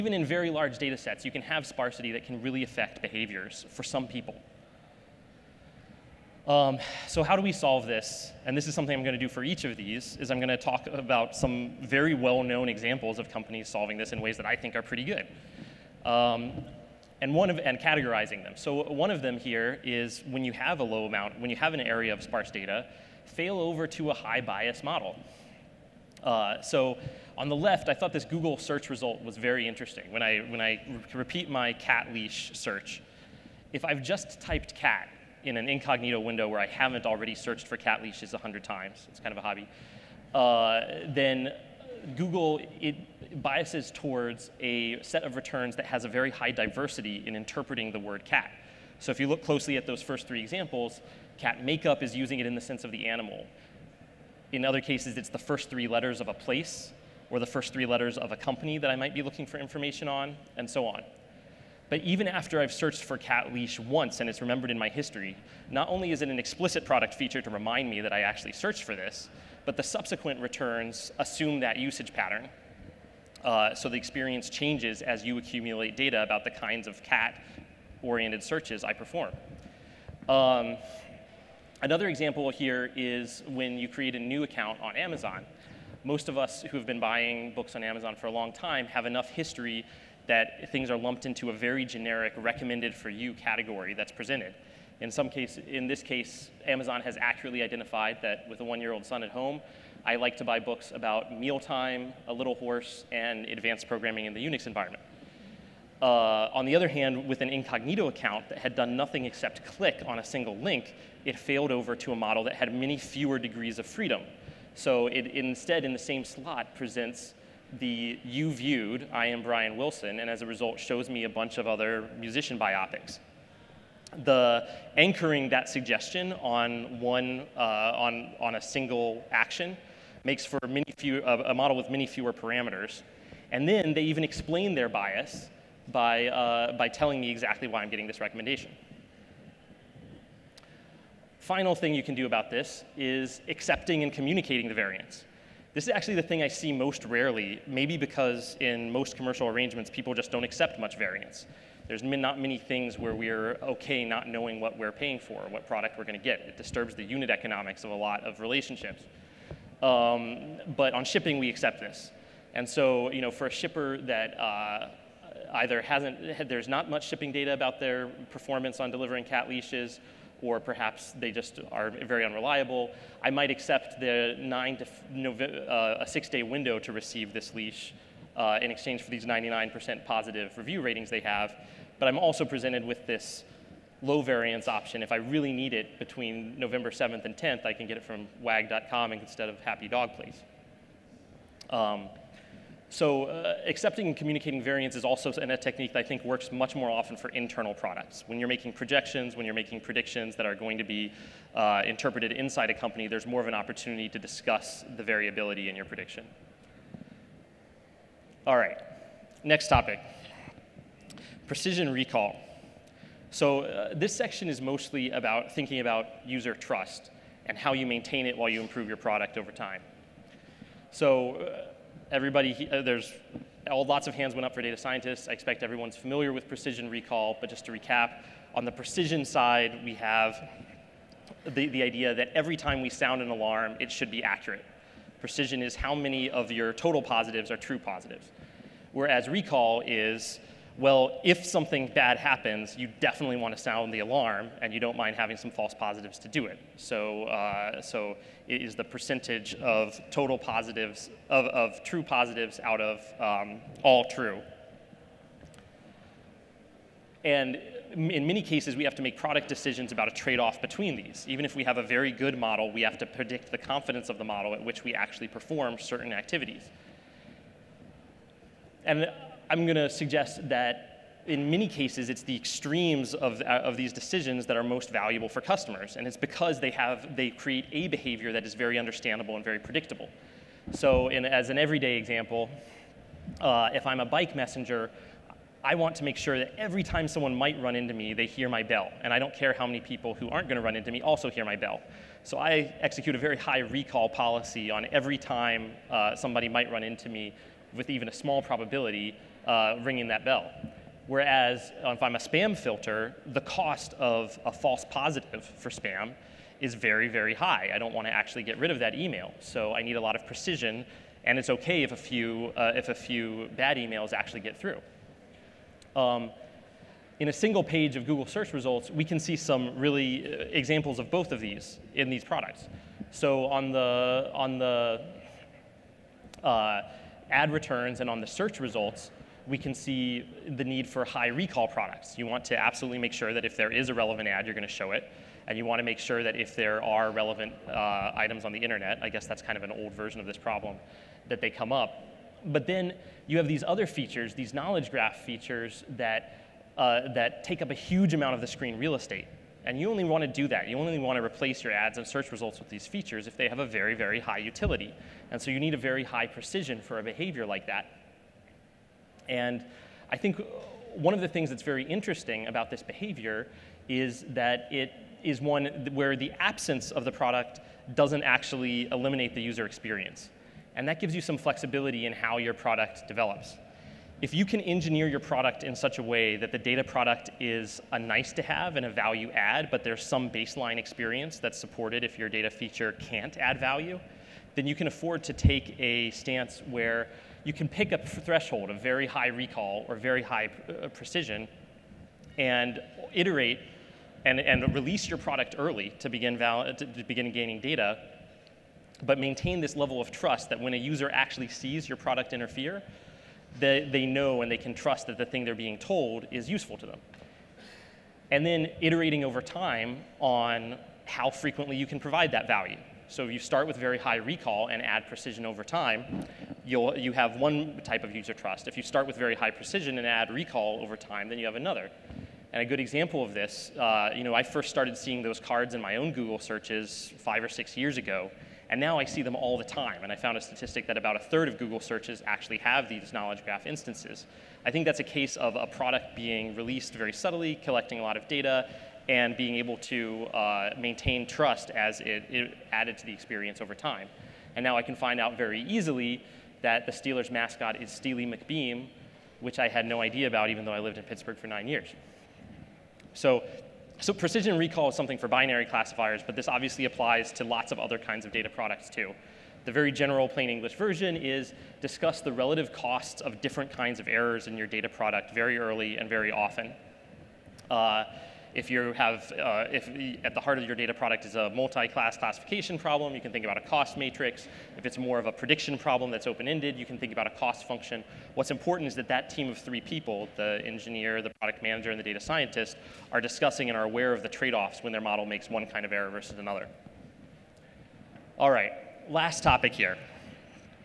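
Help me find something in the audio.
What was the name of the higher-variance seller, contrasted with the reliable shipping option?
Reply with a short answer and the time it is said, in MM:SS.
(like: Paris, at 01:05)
Happy Dog Place, at 03:09.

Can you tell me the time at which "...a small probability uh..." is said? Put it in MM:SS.
04:58.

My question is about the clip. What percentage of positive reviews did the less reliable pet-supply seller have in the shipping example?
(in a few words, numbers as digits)
99%.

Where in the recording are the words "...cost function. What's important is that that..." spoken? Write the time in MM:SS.
07:57.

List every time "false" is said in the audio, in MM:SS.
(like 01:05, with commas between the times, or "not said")
04:05, 05:04.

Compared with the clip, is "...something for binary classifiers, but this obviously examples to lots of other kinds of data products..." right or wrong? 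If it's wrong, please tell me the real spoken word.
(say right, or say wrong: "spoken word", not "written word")
wrong: "applies", not "examples".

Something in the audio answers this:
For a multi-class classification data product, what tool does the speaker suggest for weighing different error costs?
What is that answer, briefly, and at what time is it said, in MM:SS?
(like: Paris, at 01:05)
cost matrix, at 07:53.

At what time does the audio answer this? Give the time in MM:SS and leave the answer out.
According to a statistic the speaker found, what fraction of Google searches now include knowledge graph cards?
07:11.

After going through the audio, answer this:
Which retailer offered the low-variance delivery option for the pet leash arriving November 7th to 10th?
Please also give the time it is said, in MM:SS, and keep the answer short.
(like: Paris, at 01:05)
wag.com, at 03:08.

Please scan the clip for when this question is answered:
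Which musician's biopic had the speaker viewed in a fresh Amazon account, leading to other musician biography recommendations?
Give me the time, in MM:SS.
01:59.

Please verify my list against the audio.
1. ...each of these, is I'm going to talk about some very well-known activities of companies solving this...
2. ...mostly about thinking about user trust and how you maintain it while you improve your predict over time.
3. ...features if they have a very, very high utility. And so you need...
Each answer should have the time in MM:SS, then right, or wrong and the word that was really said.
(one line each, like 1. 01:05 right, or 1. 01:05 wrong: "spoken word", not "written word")
1. 00:09 wrong: "examples", not "activities"
2. 03:34 wrong: "product", not "predict"
3. 05:52 right.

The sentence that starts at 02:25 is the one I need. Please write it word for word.
This is actually the thing I see most rarely, maybe because in most commercial arrangements, people just don't accept much variance.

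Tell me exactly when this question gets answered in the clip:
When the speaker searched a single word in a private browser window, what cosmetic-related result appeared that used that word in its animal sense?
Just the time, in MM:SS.
00:51.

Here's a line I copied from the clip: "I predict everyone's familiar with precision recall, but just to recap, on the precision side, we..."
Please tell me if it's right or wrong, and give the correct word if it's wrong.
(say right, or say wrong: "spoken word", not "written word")
wrong: "expect", not "predict".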